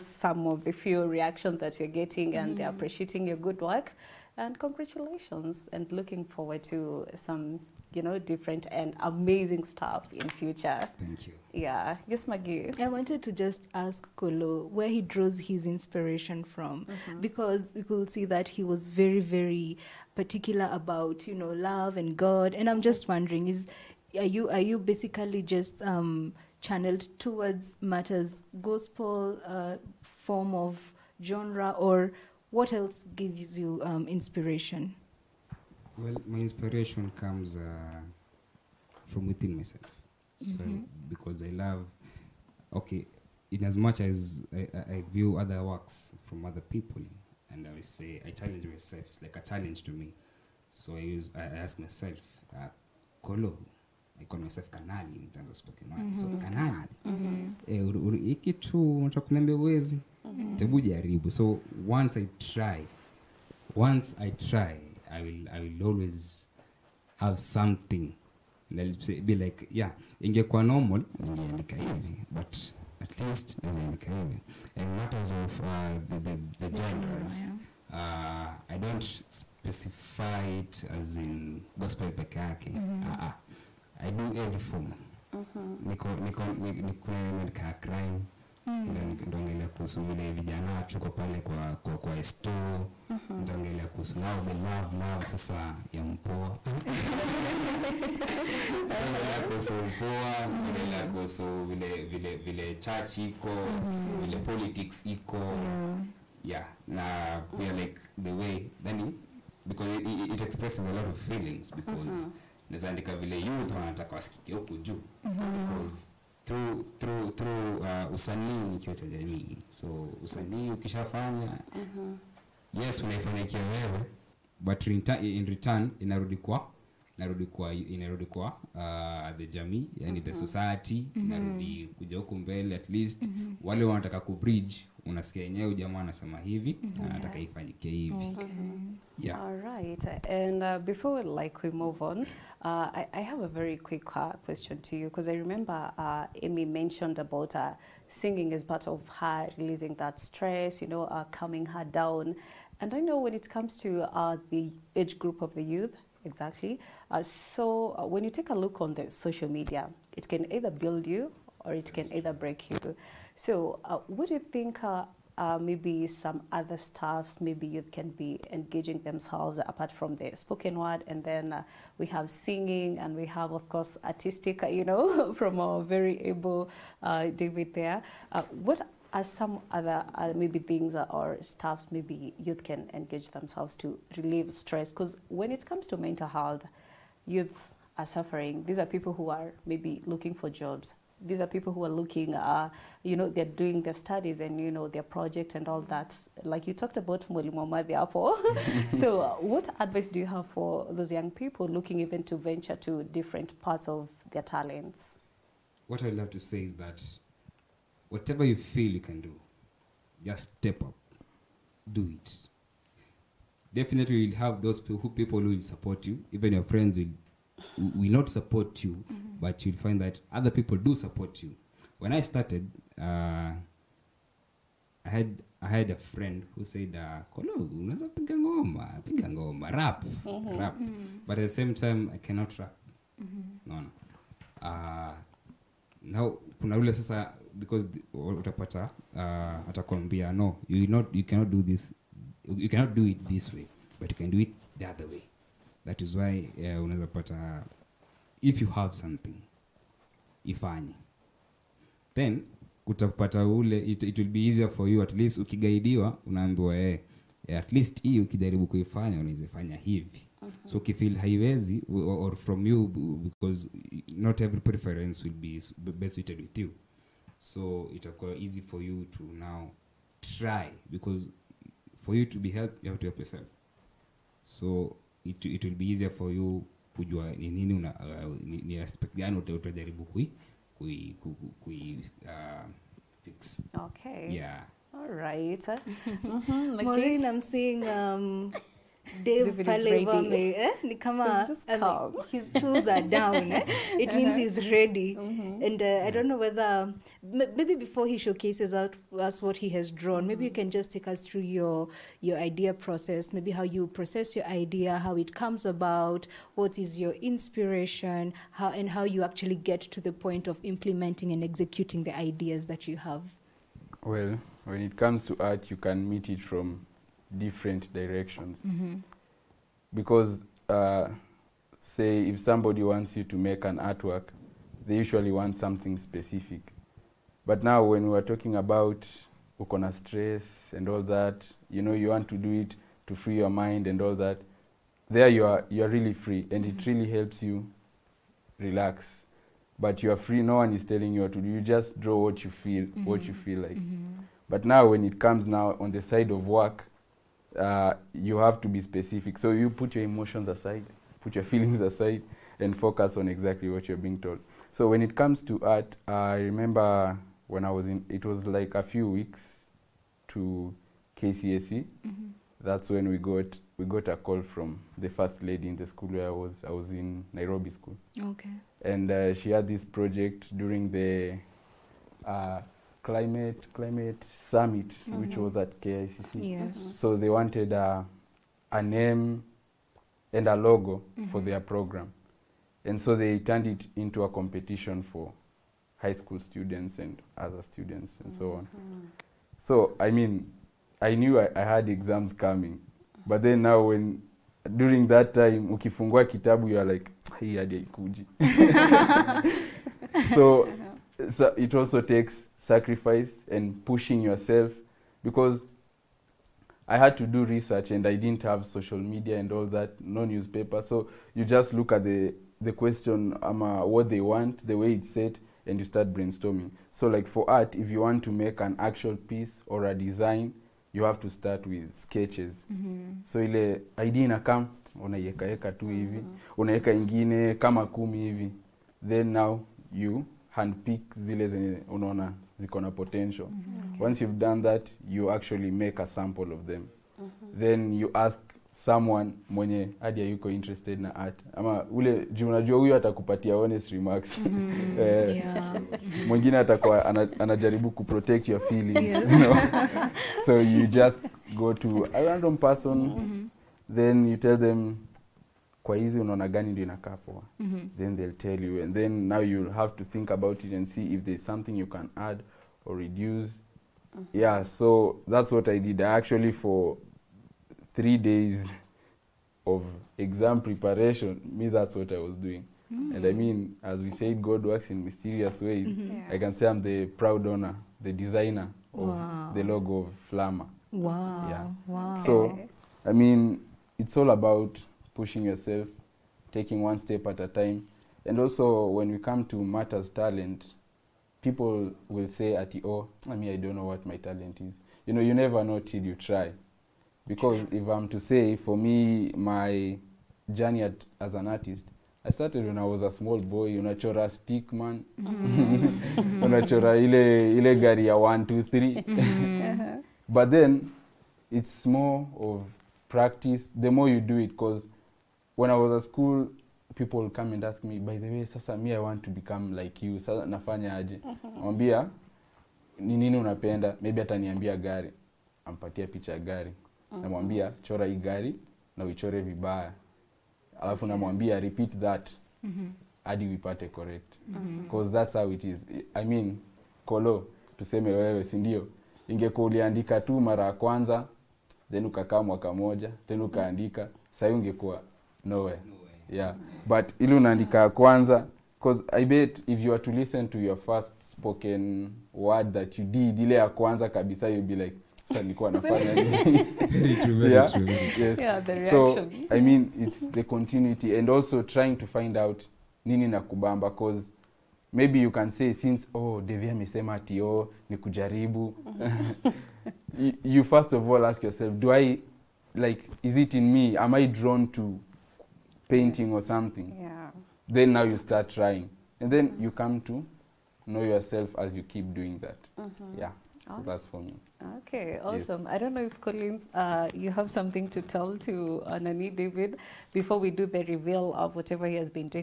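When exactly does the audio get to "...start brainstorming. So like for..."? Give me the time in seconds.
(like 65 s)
415 s.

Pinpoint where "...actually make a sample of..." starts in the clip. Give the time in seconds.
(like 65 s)
435 s.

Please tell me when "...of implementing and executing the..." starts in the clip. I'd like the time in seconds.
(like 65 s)
310 s.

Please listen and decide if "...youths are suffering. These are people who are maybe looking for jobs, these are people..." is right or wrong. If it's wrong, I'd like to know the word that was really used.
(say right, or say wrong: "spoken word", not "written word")
right.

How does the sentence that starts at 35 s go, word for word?
Well, my inspiration comes uh, from within myself.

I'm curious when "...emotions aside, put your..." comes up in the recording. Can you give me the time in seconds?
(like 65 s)
350 s.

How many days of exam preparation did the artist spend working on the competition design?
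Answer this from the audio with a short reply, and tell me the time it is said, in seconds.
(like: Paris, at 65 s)
3, at 467 s.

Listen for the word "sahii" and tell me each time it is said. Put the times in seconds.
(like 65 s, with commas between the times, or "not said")
544 s.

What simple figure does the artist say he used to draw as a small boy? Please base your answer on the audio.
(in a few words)
Stick man.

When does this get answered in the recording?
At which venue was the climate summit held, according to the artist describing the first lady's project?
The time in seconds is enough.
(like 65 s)
375 s.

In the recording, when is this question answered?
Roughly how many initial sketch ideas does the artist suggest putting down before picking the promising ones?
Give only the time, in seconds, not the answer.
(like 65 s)
427 s.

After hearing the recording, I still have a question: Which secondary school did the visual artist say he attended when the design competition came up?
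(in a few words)
Nairobi School.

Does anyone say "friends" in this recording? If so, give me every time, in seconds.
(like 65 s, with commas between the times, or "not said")
216 s, 225 s.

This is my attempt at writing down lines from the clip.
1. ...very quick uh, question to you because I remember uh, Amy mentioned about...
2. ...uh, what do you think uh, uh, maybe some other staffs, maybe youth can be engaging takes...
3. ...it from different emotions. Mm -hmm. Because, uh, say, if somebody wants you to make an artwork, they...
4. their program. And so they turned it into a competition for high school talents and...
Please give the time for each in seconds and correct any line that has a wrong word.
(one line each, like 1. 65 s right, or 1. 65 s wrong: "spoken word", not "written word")
1. 143 s right
2. 163 s wrong: "themselves", not "takes"
3. 316 s wrong: "directions", not "emotions"
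4. 381 s wrong: "students", not "talents".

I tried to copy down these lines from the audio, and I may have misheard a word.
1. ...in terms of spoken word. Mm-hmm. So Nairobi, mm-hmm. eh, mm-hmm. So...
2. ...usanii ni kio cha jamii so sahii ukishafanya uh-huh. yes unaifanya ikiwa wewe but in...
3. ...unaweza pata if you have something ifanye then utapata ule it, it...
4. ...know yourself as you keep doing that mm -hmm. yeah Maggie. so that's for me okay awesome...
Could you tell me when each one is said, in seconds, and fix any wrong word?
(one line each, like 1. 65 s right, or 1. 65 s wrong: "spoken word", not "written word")
1. 55 s wrong: "Kanali", not "Nairobi"
2. 118 s wrong: "usanii", not "sahii"
3. 246 s right
4. 580 s wrong: "Awesome", not "Maggie".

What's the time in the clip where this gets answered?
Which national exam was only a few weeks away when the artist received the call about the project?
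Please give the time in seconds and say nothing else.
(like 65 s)
361 s.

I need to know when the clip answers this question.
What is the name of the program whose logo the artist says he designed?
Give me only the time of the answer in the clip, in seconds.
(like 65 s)
480 s.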